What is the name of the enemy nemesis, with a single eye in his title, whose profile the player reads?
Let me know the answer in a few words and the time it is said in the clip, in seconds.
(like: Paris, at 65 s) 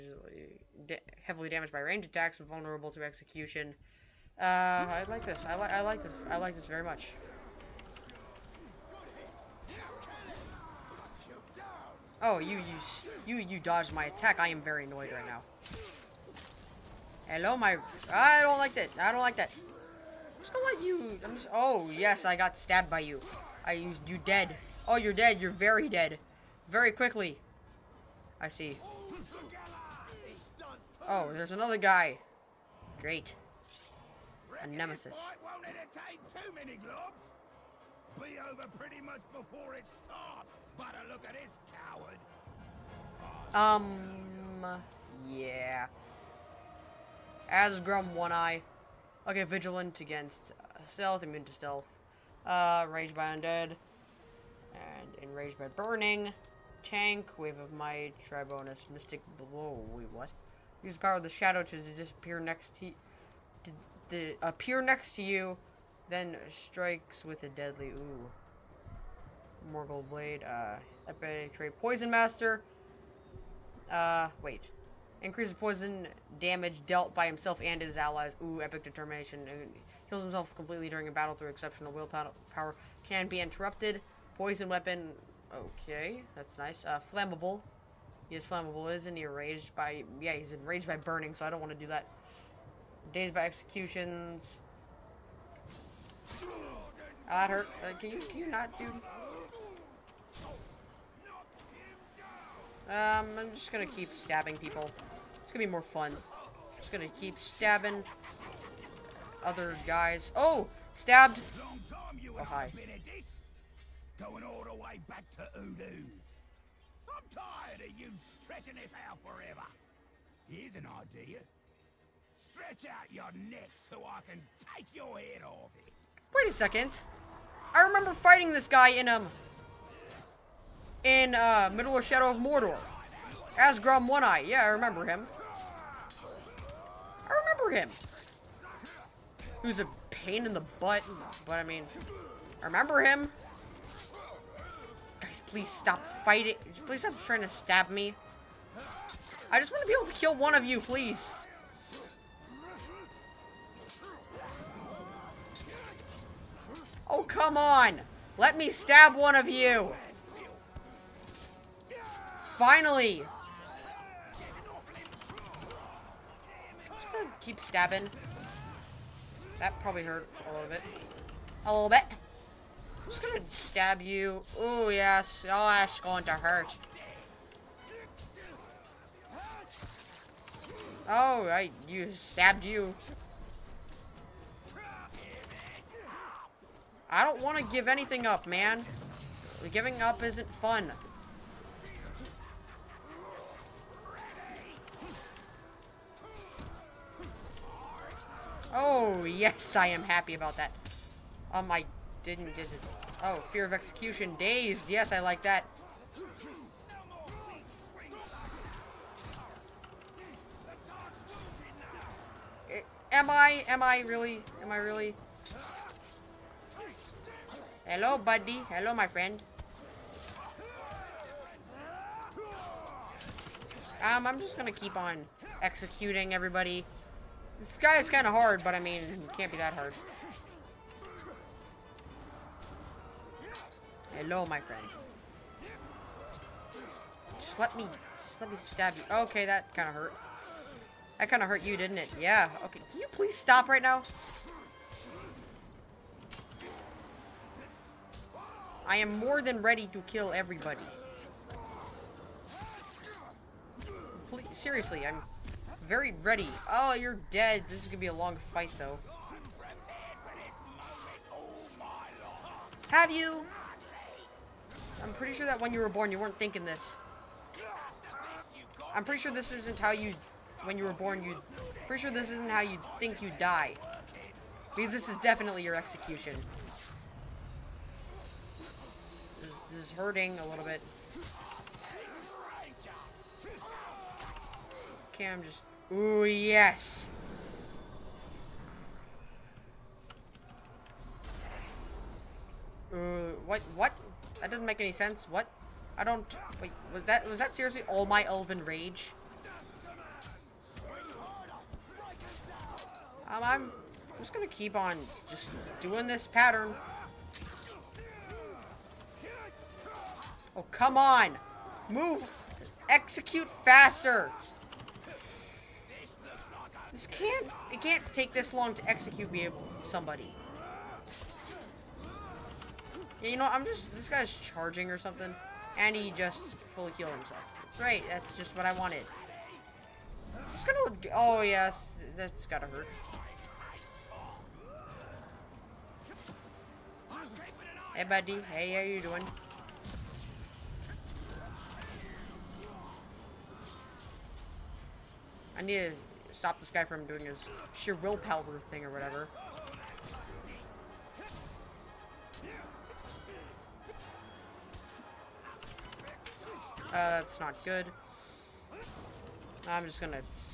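Asgrim One Eye, at 47 s.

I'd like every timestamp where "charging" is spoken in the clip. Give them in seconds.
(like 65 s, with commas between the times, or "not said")
324 s.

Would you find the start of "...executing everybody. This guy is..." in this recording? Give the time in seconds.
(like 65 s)
225 s.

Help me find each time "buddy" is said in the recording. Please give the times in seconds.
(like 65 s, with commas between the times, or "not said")
218 s, 338 s.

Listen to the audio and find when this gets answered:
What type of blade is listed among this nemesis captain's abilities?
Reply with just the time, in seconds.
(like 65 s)
69 s.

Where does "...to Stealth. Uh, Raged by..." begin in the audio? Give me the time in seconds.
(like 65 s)
51 s.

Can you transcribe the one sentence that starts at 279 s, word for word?
This, this is hurting a little bit.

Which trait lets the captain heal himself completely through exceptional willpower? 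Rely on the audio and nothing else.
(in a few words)
epic determination.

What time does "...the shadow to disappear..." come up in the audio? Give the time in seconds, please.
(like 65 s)
61 s.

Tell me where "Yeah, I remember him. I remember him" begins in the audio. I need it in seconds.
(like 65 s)
134 s.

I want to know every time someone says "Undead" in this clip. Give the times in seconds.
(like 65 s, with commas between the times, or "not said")
53 s.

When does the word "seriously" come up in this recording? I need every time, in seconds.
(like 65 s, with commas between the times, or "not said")
254 s, 297 s.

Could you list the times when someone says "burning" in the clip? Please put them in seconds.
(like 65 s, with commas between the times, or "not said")
55 s, 90 s.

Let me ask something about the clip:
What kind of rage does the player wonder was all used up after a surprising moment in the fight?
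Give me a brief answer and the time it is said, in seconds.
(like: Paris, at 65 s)
elven rage, at 298 s.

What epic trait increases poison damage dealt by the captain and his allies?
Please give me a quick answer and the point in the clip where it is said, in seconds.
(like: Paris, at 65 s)
Poison Master, at 71 s.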